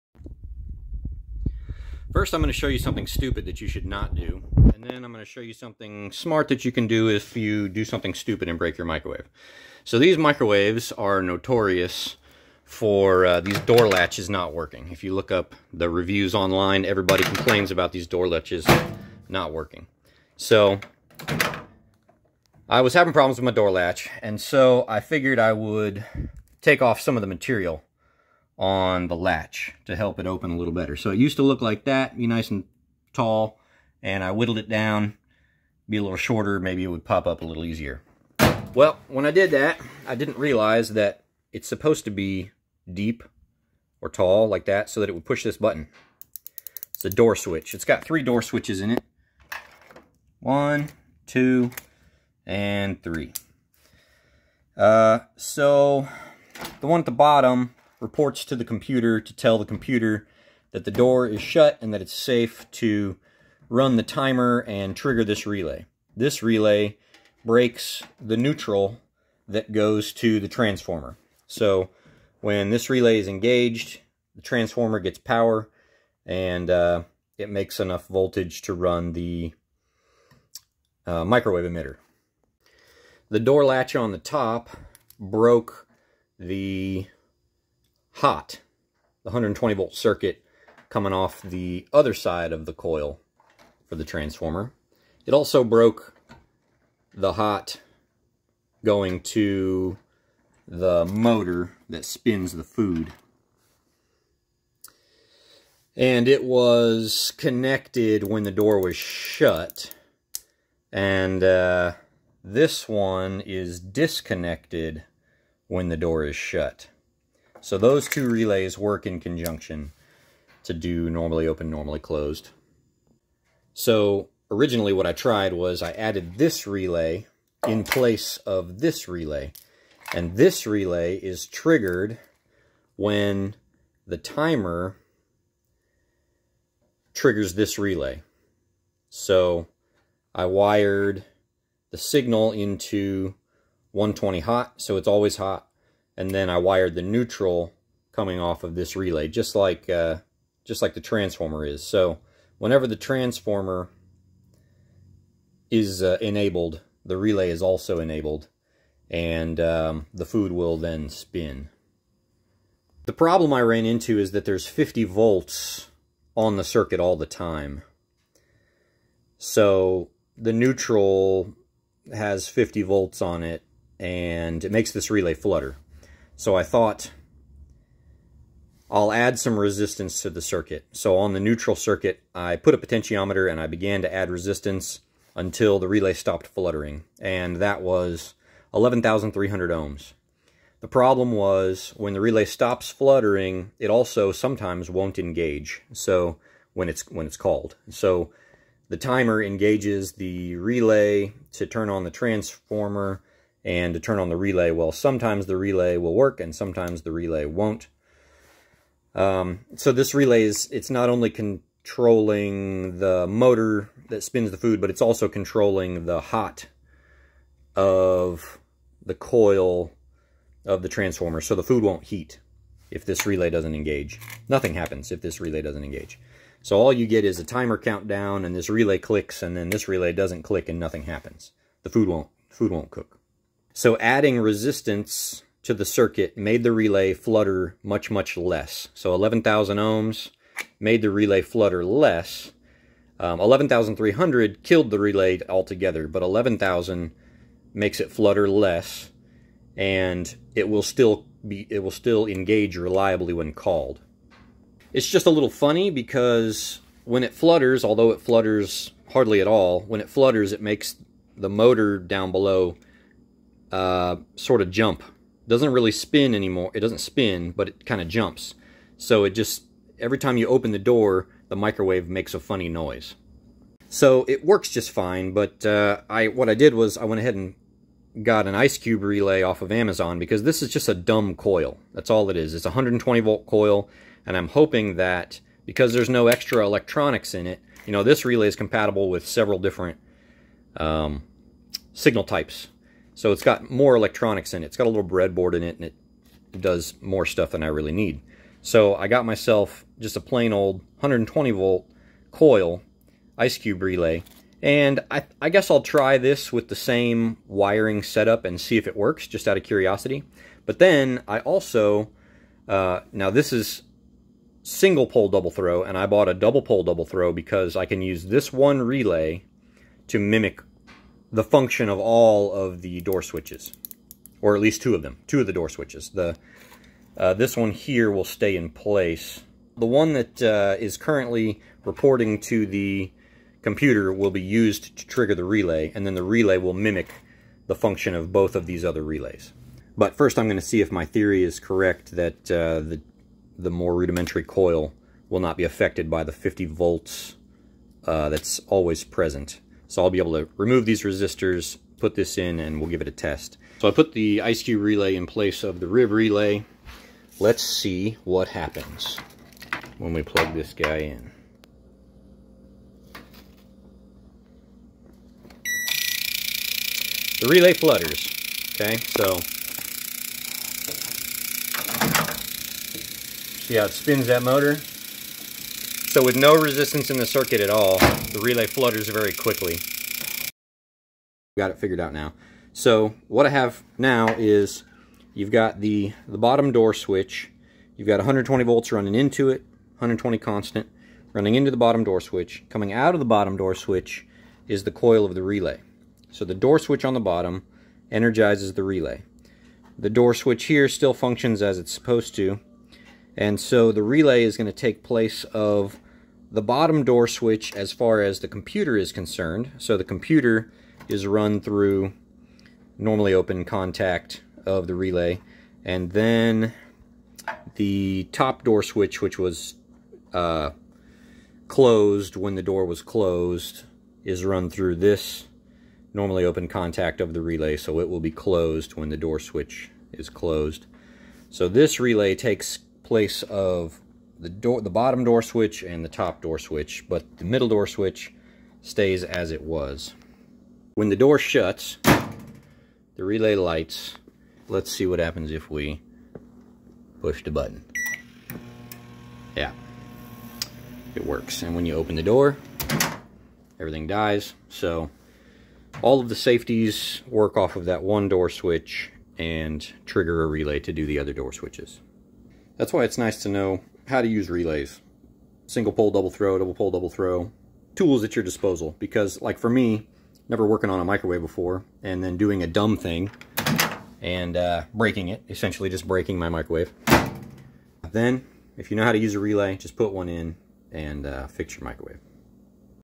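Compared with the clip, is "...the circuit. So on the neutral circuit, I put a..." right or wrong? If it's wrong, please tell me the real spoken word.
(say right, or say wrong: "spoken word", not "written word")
right.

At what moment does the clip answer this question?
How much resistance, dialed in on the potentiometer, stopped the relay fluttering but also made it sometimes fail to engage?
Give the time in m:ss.
3:08.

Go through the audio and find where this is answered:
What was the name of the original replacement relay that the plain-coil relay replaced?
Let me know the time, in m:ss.
5:55.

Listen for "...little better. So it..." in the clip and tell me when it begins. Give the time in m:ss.
0:30.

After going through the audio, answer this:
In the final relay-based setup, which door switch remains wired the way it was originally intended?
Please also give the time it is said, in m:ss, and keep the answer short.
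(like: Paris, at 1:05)
the middle, at 7:17.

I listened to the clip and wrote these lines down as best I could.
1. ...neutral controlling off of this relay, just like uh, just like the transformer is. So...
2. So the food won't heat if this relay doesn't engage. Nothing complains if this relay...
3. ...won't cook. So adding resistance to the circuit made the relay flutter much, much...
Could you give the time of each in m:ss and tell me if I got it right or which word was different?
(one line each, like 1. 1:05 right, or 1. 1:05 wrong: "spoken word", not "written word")
1. 2:27 wrong: "coming", not "controlling"
2. 3:41 wrong: "happens", not "complains"
3. 3:52 right.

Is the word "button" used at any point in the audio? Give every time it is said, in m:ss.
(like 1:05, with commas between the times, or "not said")
0:45, 7:27.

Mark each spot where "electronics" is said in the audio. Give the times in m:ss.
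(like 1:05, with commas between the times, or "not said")
4:46, 4:53.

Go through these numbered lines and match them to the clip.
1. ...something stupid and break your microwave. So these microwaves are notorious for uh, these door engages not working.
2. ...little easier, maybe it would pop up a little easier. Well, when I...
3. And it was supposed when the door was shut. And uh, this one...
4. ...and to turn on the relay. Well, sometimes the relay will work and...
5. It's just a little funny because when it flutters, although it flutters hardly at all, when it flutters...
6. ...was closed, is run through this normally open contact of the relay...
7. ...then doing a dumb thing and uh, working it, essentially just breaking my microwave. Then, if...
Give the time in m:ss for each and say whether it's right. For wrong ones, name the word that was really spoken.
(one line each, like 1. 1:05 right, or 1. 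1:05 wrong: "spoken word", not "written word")
1. 0:07 wrong: "latches", not "engages"
2. 0:36 wrong: "shorter", not "easier"
3. 1:45 wrong: "connected", not "supposed"
4. 3:23 right
5. 4:14 right
6. 7:02 right
7. 7:52 wrong: "breaking", not "working".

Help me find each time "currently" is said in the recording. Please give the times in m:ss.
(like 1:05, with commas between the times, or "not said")
5:30.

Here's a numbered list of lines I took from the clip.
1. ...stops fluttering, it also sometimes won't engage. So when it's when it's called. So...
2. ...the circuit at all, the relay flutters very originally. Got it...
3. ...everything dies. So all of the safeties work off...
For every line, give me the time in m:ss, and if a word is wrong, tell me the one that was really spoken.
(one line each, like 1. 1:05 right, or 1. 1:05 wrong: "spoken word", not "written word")
1. 3:12 right
2. 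6:17 wrong: "quickly", not "originally"
3. 7:33 right.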